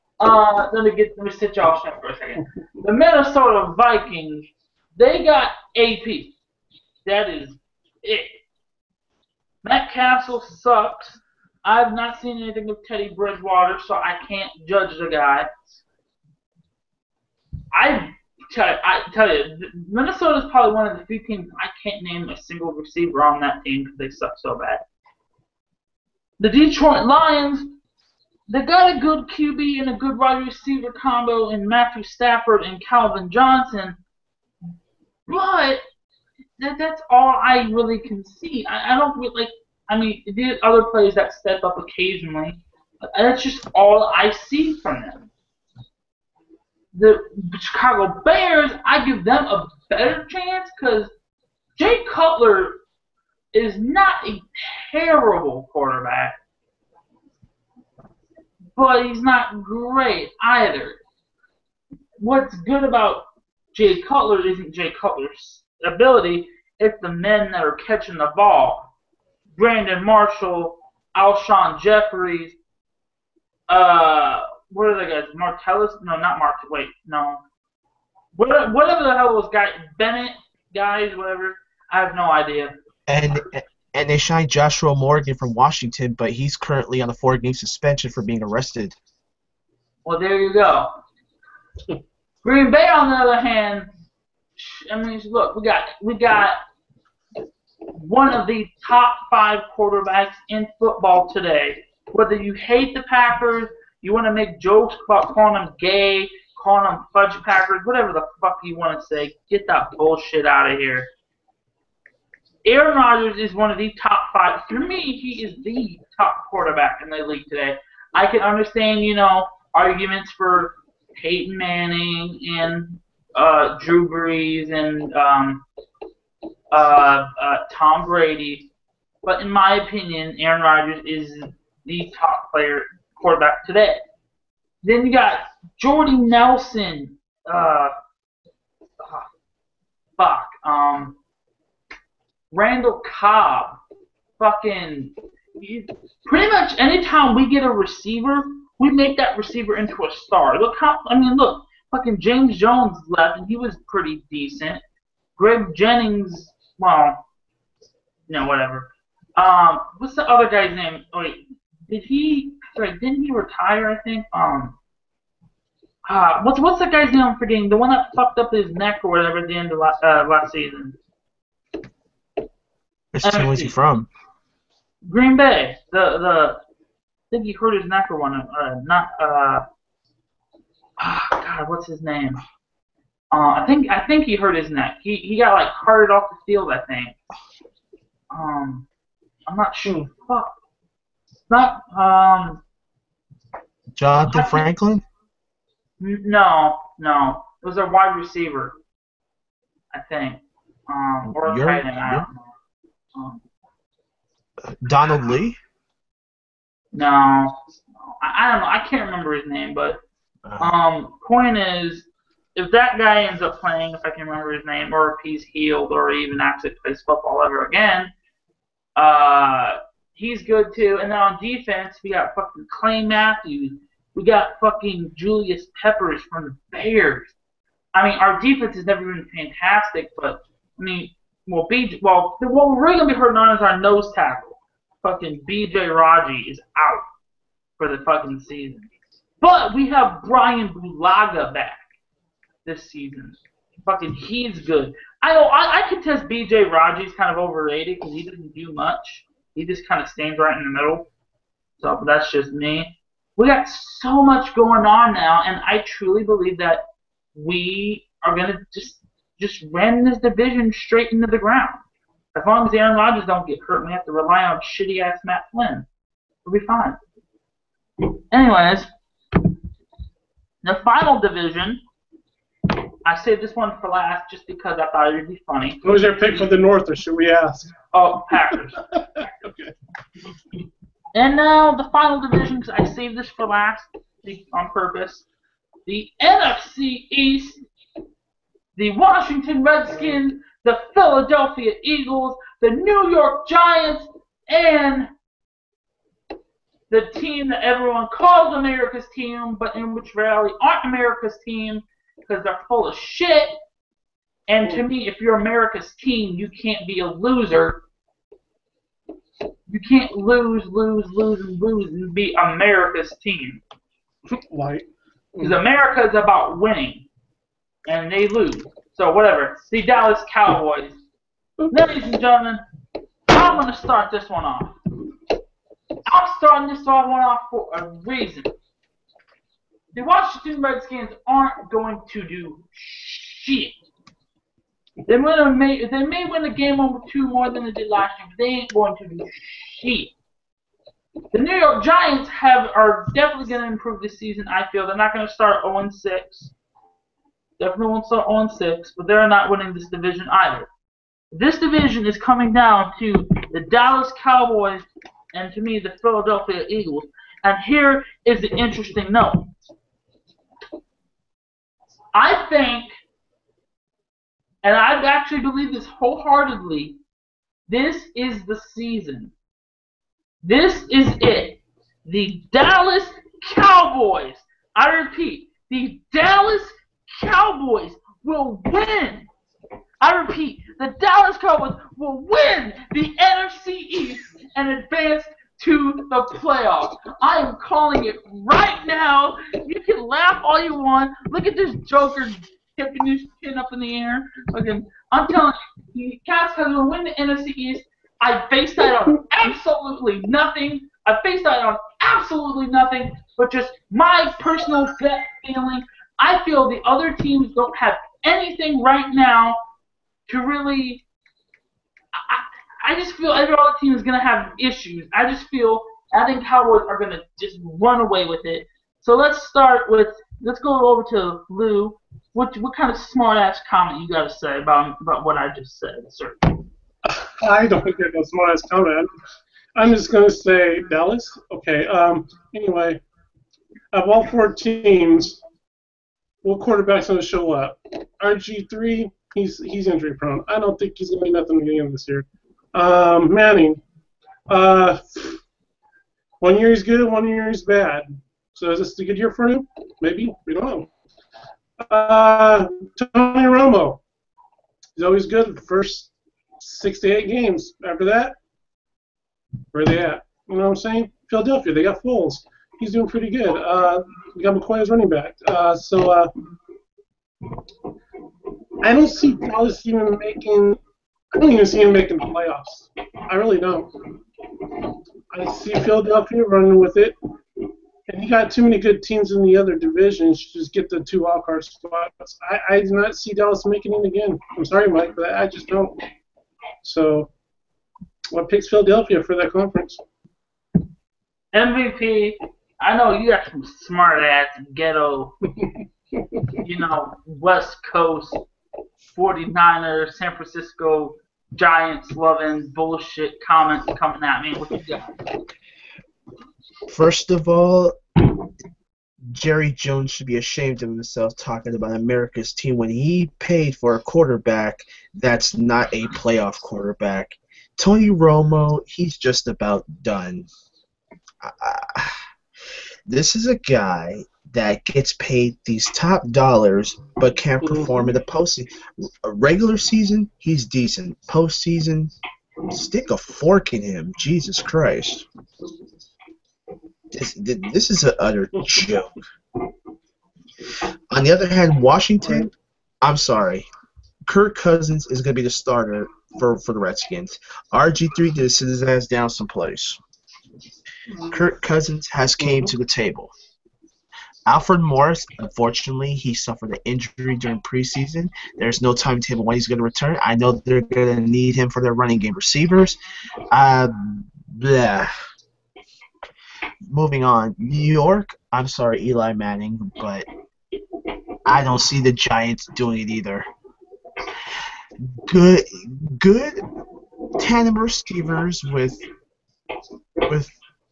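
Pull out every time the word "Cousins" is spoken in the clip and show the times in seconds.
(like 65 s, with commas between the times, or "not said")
544 s, 551 s.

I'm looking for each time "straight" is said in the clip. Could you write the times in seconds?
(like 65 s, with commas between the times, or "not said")
1 s, 260 s.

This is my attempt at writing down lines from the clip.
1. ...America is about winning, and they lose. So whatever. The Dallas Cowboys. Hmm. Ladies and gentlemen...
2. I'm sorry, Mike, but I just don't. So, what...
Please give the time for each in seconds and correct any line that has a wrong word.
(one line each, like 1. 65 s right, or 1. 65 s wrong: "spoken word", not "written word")
1. 315 s right
2. 484 s right.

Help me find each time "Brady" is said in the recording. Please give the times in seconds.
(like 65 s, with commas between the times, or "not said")
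128 s.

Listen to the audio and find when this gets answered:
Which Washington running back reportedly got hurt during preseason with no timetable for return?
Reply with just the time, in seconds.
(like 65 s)
554 s.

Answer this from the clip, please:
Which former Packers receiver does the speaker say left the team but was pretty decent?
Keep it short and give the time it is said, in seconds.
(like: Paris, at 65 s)
James Jones, at 152 s.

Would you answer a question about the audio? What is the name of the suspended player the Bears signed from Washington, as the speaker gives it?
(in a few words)
Joshua Morgan.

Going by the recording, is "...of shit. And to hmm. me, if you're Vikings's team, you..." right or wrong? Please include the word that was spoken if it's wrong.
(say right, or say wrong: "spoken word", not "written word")
wrong: "America", not "Vikings".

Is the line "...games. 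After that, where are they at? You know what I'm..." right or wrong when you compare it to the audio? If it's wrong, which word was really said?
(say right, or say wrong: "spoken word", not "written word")
right.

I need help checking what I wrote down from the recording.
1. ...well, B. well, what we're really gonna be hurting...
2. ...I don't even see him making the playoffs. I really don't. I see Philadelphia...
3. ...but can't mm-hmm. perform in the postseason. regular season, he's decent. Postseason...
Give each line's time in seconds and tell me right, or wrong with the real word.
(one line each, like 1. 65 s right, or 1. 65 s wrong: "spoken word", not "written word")
1. 231 s right
2. 471 s right
3. 527 s right.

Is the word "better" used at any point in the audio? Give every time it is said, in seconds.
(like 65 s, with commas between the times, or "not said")
49 s.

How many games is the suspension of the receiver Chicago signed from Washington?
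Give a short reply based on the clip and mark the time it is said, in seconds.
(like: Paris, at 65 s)
4, at 87 s.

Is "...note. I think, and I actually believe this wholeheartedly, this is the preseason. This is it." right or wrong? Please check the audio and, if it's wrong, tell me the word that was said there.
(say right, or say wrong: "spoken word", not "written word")
wrong: "season", not "preseason".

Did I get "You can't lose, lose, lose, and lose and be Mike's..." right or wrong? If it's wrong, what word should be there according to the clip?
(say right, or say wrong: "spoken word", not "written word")
wrong: "America", not "Mike".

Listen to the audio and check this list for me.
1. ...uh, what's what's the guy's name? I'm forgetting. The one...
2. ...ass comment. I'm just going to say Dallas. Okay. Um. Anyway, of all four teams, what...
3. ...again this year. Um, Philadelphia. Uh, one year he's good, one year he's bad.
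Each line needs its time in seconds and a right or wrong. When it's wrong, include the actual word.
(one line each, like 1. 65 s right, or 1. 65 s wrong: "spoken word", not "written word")
1. 166 s right
2. 428 s right
3. 441 s wrong: "Manning", not "Philadelphia".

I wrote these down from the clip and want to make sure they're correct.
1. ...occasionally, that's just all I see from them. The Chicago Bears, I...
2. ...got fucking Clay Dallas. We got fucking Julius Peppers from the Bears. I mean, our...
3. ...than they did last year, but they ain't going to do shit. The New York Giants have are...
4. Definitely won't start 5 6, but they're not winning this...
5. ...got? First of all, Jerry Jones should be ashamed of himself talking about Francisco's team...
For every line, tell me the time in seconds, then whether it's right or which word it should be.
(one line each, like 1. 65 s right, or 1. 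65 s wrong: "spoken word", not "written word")
1. 41 s right
2. 222 s wrong: "Matthews", not "Dallas"
3. 337 s right
4. 347 s wrong: "0", not "5"
5. 504 s wrong: "America", not "Francisco".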